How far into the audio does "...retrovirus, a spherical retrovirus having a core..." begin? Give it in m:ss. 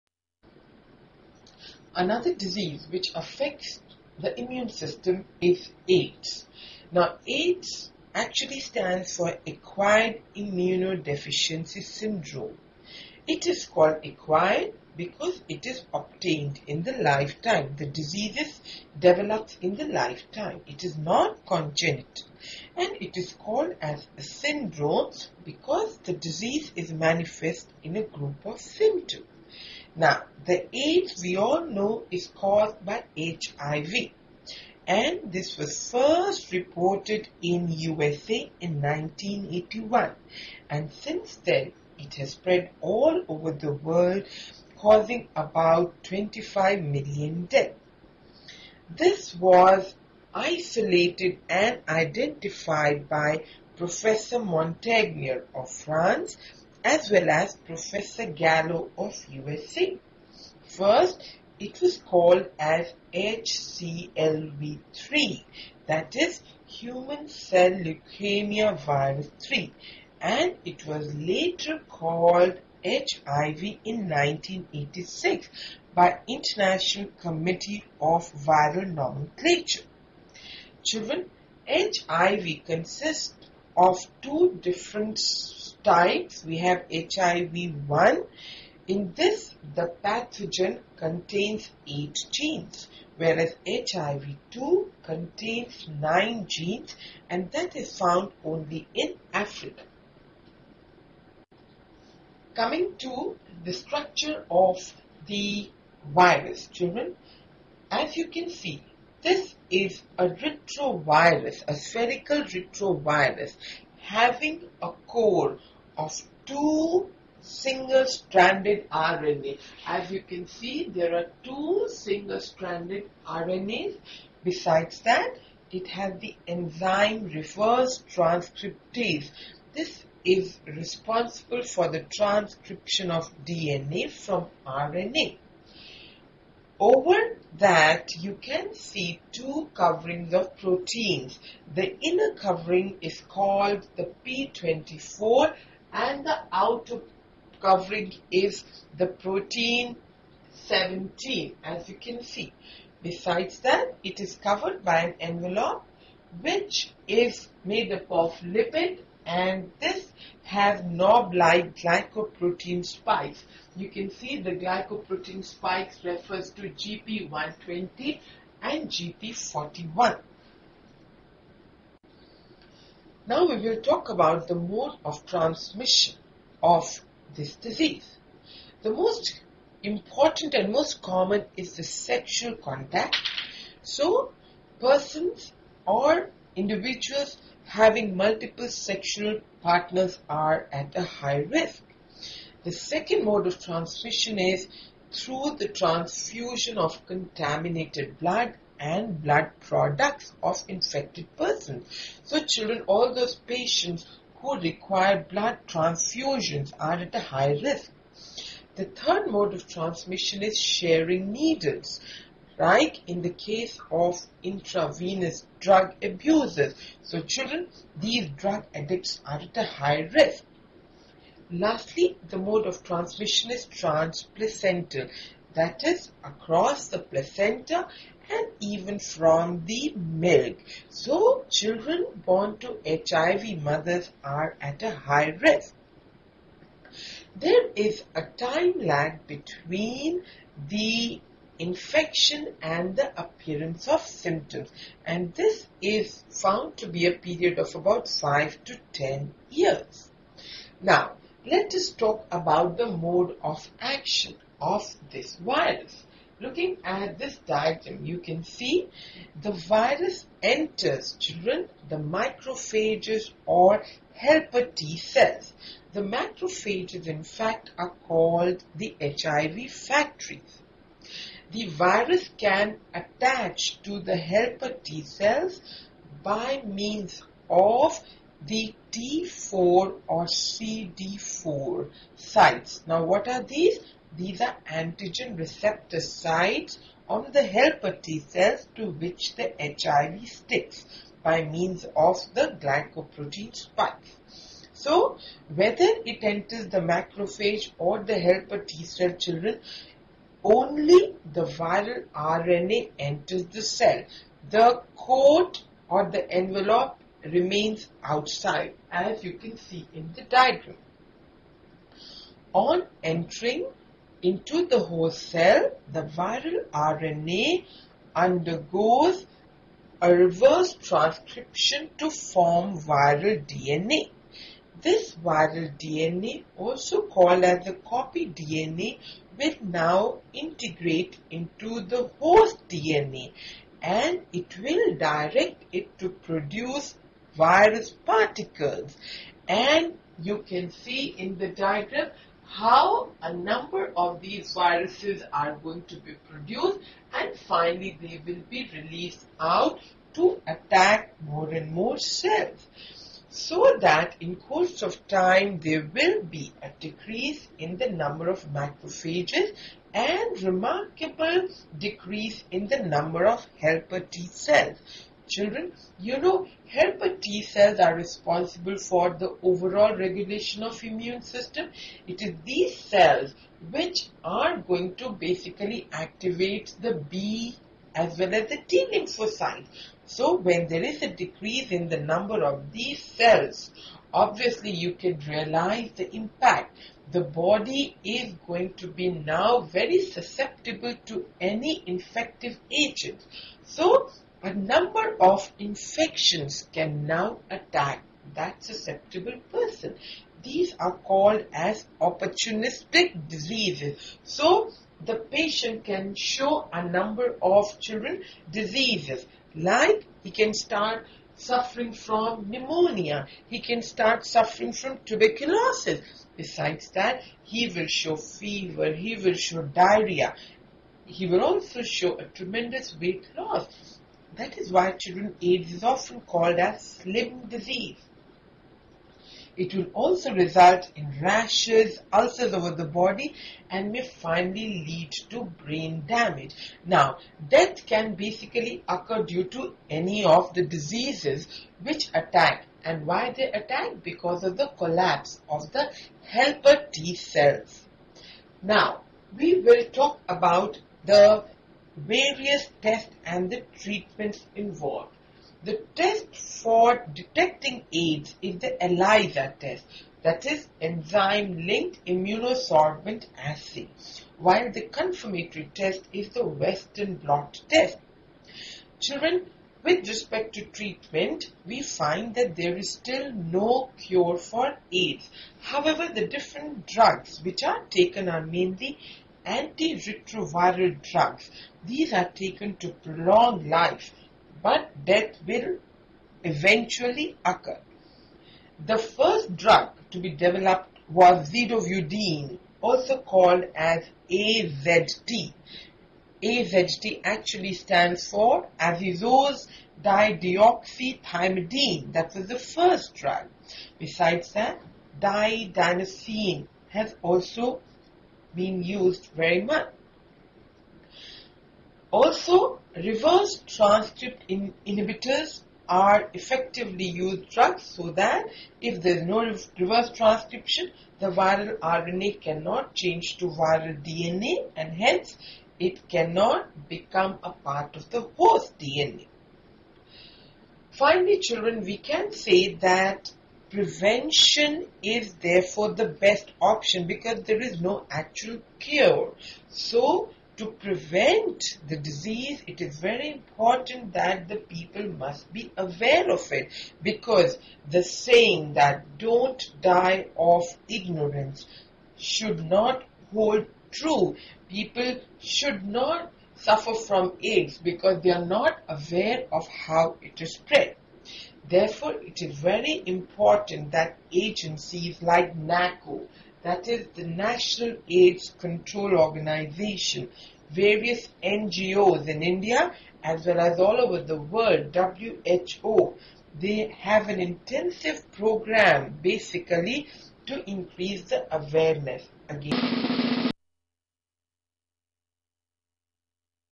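1:50.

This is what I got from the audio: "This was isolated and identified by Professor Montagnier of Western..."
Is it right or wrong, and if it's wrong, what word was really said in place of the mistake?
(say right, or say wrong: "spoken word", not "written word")
wrong: "France", not "Western".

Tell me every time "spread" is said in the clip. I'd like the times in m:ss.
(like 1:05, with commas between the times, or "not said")
0:42, 9:20.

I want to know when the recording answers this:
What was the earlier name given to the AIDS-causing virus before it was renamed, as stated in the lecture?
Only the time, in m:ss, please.
1:03.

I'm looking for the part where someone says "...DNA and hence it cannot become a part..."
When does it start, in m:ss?
8:44.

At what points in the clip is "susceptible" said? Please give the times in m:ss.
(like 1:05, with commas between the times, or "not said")
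6:30, 6:38.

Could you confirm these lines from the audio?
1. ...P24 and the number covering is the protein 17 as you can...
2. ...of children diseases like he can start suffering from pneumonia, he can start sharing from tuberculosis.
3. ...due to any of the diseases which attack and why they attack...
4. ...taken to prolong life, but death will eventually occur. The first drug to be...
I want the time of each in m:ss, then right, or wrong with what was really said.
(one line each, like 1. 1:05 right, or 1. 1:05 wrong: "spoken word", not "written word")
1. 2:24 wrong: "outer", not "number"
2. 6:47 wrong: "suffering", not "sharing"
3. 7:19 right
4. 8:02 right.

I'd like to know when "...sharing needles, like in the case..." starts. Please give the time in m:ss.
3:30.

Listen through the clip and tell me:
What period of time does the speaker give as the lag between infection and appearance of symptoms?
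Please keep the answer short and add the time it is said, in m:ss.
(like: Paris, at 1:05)
5 to 10 years, at 4:08.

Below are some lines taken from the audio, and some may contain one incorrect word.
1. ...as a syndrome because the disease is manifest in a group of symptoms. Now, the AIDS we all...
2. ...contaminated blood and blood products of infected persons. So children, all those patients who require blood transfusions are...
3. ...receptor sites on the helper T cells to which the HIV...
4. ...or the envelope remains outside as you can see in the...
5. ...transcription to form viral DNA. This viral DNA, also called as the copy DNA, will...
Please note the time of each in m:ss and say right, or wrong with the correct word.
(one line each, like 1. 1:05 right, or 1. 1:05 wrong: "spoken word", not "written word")
1. 0:23 right
2. 3:17 right
3. 4:45 right
4. 5:05 right
5. 5:20 right.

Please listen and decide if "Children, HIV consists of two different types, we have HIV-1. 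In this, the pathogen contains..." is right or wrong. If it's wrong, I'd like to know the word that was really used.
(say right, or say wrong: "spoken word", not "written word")
right.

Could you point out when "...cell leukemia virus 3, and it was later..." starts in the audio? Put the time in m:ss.
1:07.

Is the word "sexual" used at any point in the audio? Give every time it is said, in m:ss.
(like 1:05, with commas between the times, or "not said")
3:01, 3:08.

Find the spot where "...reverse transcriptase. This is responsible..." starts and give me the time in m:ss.
2:07.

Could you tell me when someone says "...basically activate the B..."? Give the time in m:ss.
6:15.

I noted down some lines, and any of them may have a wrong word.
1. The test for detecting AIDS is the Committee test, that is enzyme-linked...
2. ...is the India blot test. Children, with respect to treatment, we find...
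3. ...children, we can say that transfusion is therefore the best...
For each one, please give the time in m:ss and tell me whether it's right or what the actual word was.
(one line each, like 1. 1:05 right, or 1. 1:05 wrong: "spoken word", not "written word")
1. 7:35 wrong: "ELISA", not "Committee"
2. 7:46 wrong: "Western", not "India"
3. 8:51 wrong: "prevention", not "transfusion".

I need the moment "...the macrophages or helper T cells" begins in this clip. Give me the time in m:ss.
4:21.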